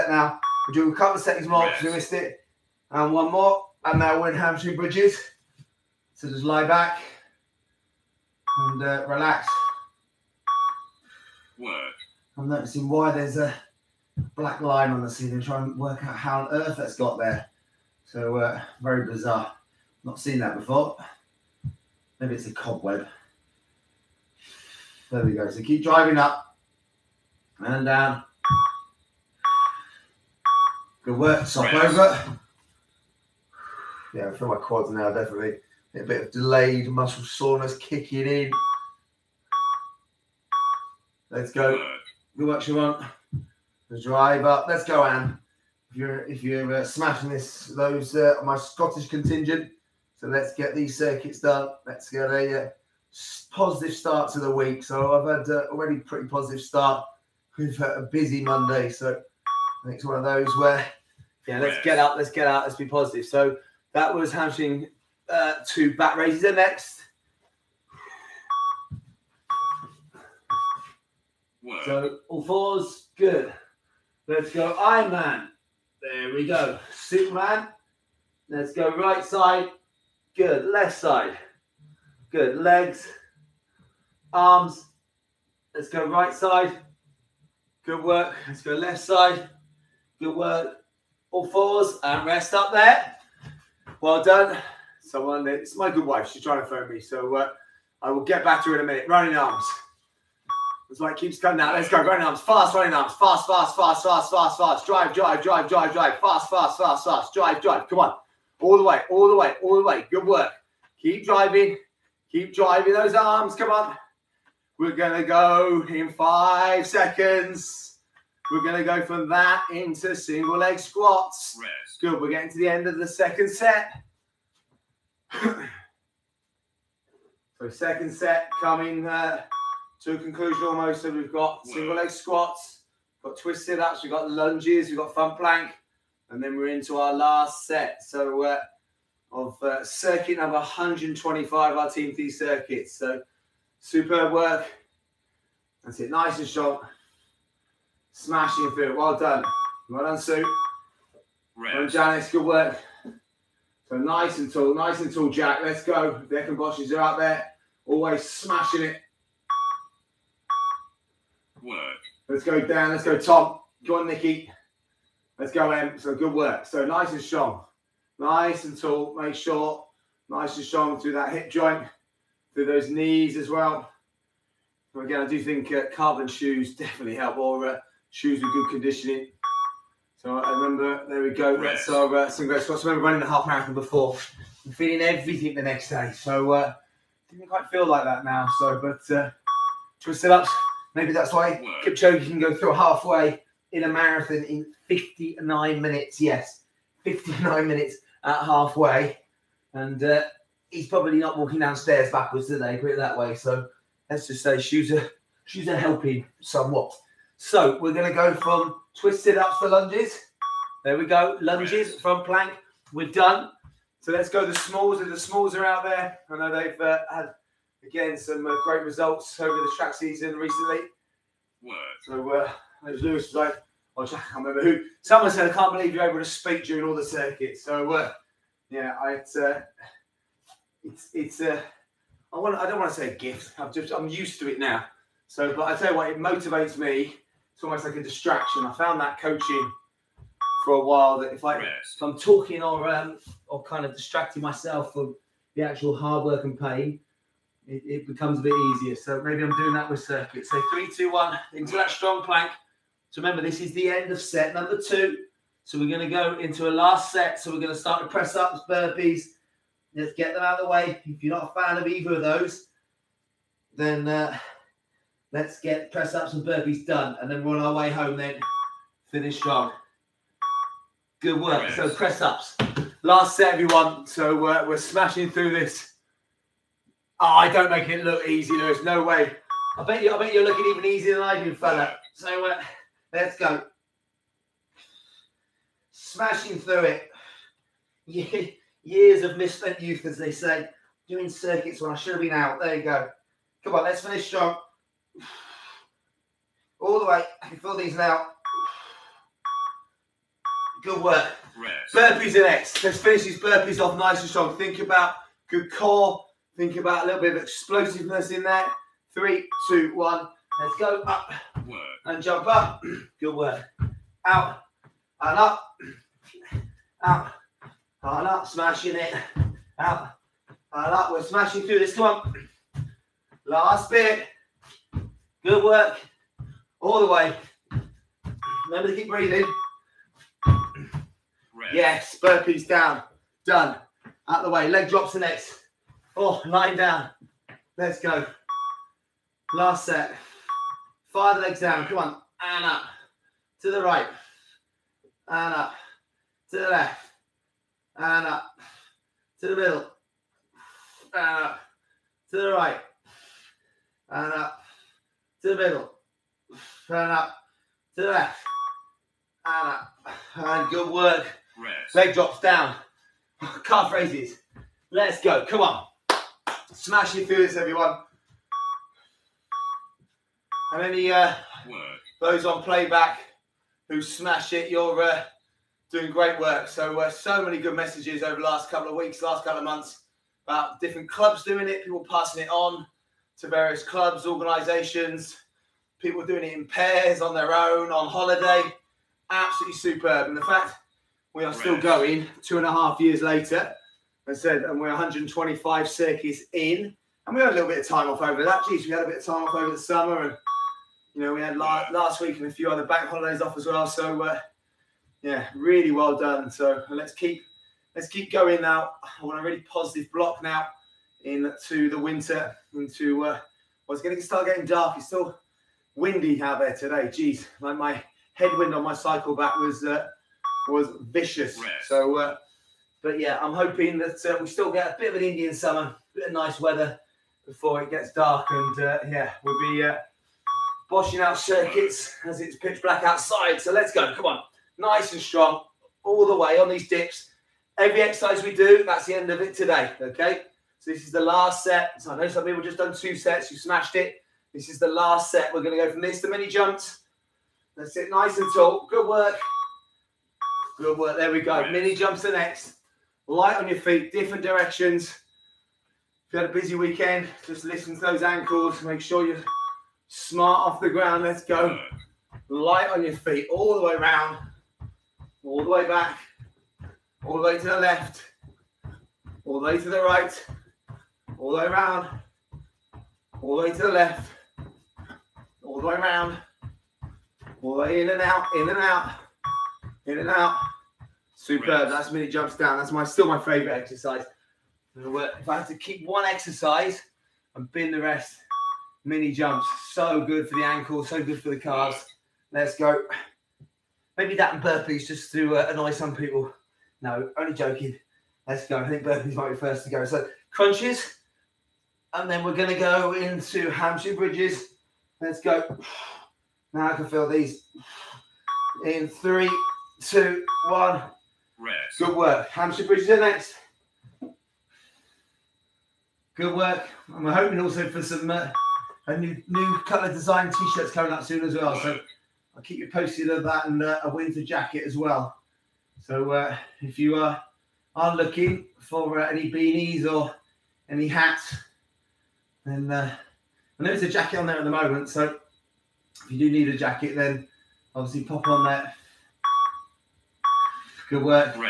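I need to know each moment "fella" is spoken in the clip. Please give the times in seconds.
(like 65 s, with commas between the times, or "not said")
281 s.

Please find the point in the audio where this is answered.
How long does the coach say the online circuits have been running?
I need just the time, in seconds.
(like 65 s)
392 s.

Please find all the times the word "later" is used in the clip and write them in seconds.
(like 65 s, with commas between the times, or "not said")
393 s.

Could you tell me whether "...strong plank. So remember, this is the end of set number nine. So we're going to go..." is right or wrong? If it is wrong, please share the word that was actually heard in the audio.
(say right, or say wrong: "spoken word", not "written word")
wrong: "two", not "nine".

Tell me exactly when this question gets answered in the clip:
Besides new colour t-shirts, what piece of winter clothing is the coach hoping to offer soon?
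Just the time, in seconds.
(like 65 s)
524 s.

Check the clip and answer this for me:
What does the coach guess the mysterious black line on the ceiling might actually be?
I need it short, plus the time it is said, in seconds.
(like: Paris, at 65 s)
A cobweb, at 22 s.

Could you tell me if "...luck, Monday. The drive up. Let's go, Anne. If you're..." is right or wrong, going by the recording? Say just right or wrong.
wrong.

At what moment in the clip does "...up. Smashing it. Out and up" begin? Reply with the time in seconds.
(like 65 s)
318 s.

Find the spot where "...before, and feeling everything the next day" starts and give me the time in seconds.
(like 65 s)
183 s.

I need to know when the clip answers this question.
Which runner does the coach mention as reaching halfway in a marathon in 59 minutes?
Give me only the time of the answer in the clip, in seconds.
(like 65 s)
191 s.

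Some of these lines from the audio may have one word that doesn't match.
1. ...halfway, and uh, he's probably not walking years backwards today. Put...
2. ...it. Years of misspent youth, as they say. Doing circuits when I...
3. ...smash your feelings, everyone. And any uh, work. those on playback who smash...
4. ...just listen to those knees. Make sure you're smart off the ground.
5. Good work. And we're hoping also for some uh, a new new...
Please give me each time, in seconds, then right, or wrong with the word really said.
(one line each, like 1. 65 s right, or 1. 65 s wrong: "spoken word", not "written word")
1. 198 s wrong: "downstairs", not "years"
2. 288 s right
3. 366 s right
4. 457 s wrong: "ankles", not "knees"
5. 516 s right.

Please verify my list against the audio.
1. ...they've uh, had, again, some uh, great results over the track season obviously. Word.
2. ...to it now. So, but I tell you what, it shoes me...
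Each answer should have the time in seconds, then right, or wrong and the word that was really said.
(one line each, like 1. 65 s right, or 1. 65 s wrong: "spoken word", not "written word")
1. 216 s wrong: "recently", not "obviously"
2. 234 s wrong: "motivates", not "shoes".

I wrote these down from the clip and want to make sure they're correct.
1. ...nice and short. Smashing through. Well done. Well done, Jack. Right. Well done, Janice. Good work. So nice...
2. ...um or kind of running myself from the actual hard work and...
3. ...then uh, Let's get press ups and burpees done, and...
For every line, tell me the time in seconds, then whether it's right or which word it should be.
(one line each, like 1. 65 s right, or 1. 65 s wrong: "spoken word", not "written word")
1. 146 s wrong: "Sue", not "Jack"
2. 242 s wrong: "distracting", not "running"
3. 263 s right.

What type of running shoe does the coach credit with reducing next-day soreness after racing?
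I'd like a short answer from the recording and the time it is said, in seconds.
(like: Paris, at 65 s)
Carbon shoes, at 175 s.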